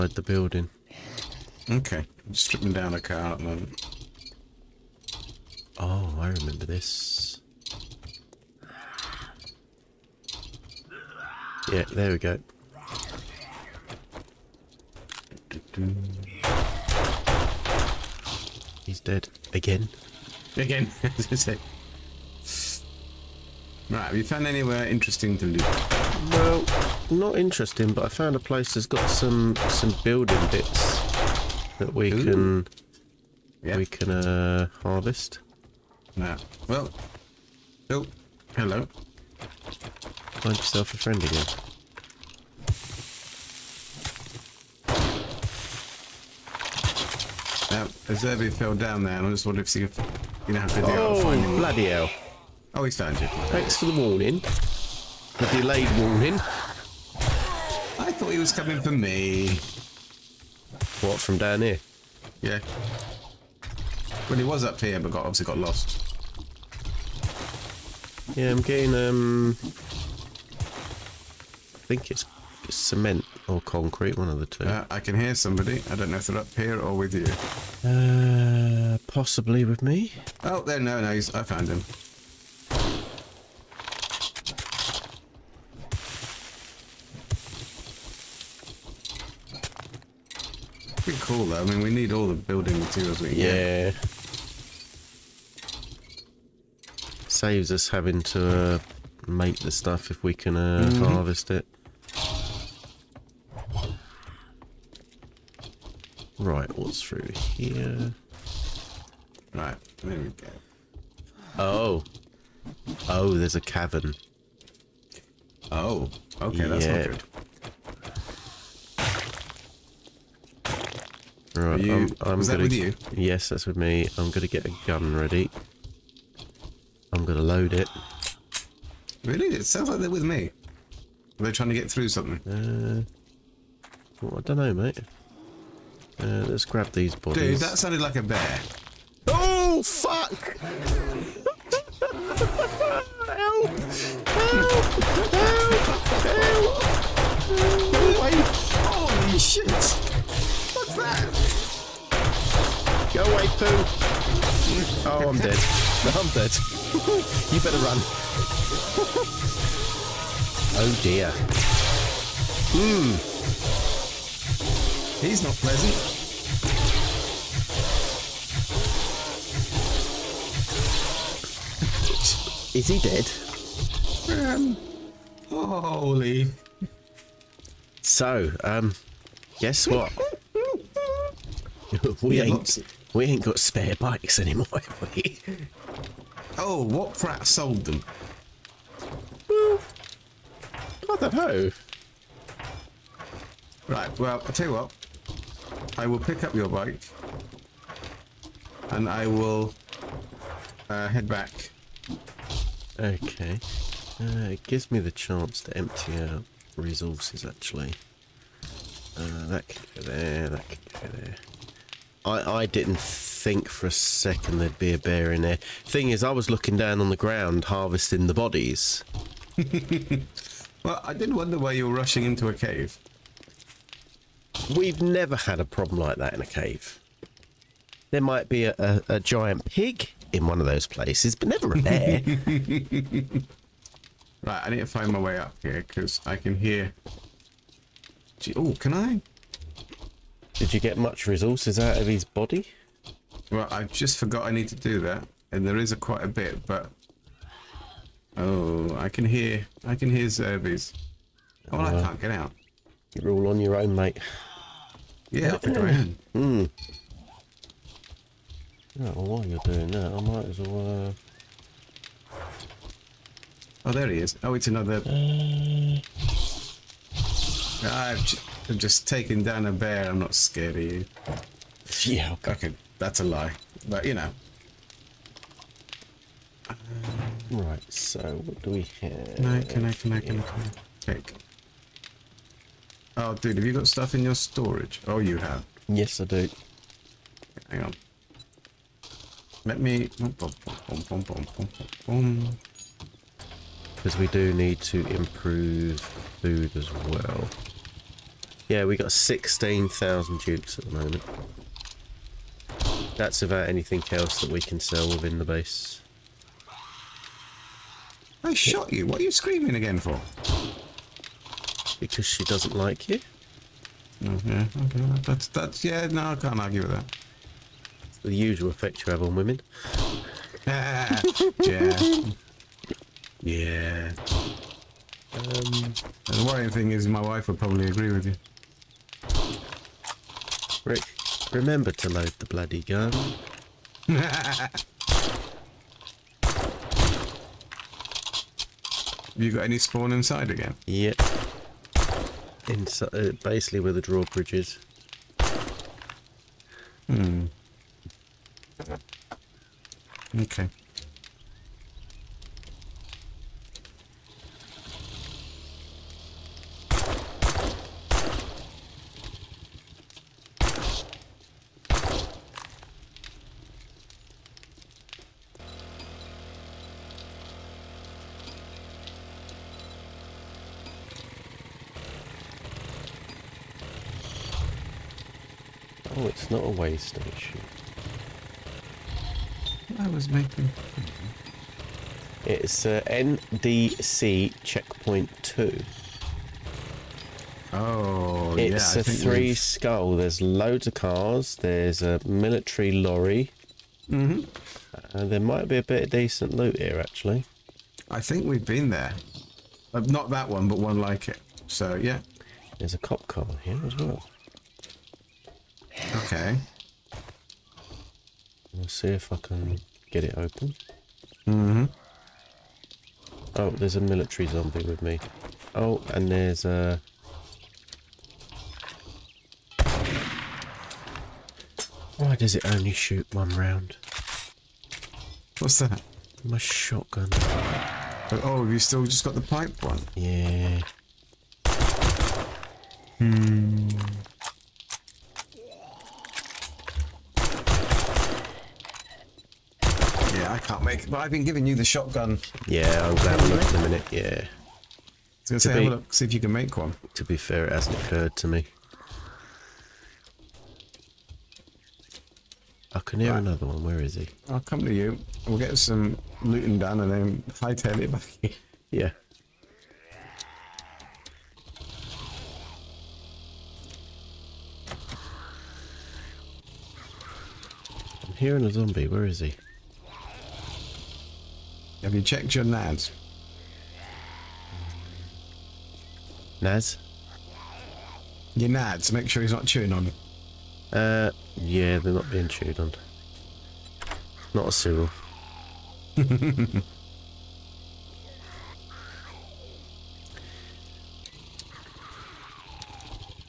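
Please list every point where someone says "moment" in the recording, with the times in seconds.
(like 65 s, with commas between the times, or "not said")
3 s, 300 s.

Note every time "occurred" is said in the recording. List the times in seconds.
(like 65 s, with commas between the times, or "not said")
447 s.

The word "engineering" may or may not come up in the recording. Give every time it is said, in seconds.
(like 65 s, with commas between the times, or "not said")
not said.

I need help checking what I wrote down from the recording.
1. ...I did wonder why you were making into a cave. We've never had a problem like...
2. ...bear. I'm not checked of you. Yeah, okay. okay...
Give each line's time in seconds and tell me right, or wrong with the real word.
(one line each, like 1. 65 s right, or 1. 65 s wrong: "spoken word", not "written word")
1. 221 s wrong: "rushing", not "making"
2. 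269 s wrong: "scared", not "checked".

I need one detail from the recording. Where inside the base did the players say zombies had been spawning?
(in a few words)
where the drawbridge is.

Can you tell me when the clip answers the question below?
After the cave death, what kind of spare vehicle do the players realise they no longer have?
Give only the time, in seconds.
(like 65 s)
183 s.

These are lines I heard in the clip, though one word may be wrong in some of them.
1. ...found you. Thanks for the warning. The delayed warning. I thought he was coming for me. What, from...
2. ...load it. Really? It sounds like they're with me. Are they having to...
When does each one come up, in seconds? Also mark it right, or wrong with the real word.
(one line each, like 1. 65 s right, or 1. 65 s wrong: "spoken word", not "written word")
1. 52 s right
2. 127 s wrong: "trying", not "having".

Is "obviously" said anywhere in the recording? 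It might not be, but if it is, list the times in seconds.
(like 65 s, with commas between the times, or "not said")
65 s.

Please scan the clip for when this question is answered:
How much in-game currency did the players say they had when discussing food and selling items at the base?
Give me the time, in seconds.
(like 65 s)
299 s.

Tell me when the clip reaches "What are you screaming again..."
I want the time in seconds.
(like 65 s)
309 s.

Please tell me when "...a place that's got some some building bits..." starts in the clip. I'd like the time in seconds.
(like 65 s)
28 s.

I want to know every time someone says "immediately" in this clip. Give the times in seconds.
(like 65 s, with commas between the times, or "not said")
not said.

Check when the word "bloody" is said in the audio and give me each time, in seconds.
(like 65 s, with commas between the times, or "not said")
51 s, 332 s.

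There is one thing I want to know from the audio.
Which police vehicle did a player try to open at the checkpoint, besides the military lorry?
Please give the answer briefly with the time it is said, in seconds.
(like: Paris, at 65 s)
cop car, at 402 s.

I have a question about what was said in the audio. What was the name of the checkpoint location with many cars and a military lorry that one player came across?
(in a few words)
NDC checkpoint two.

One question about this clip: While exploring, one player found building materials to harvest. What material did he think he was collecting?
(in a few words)
cement or concrete.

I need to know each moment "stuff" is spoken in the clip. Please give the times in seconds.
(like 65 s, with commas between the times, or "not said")
99 s, 283 s.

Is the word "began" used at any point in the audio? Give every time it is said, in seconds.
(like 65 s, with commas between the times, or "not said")
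not said.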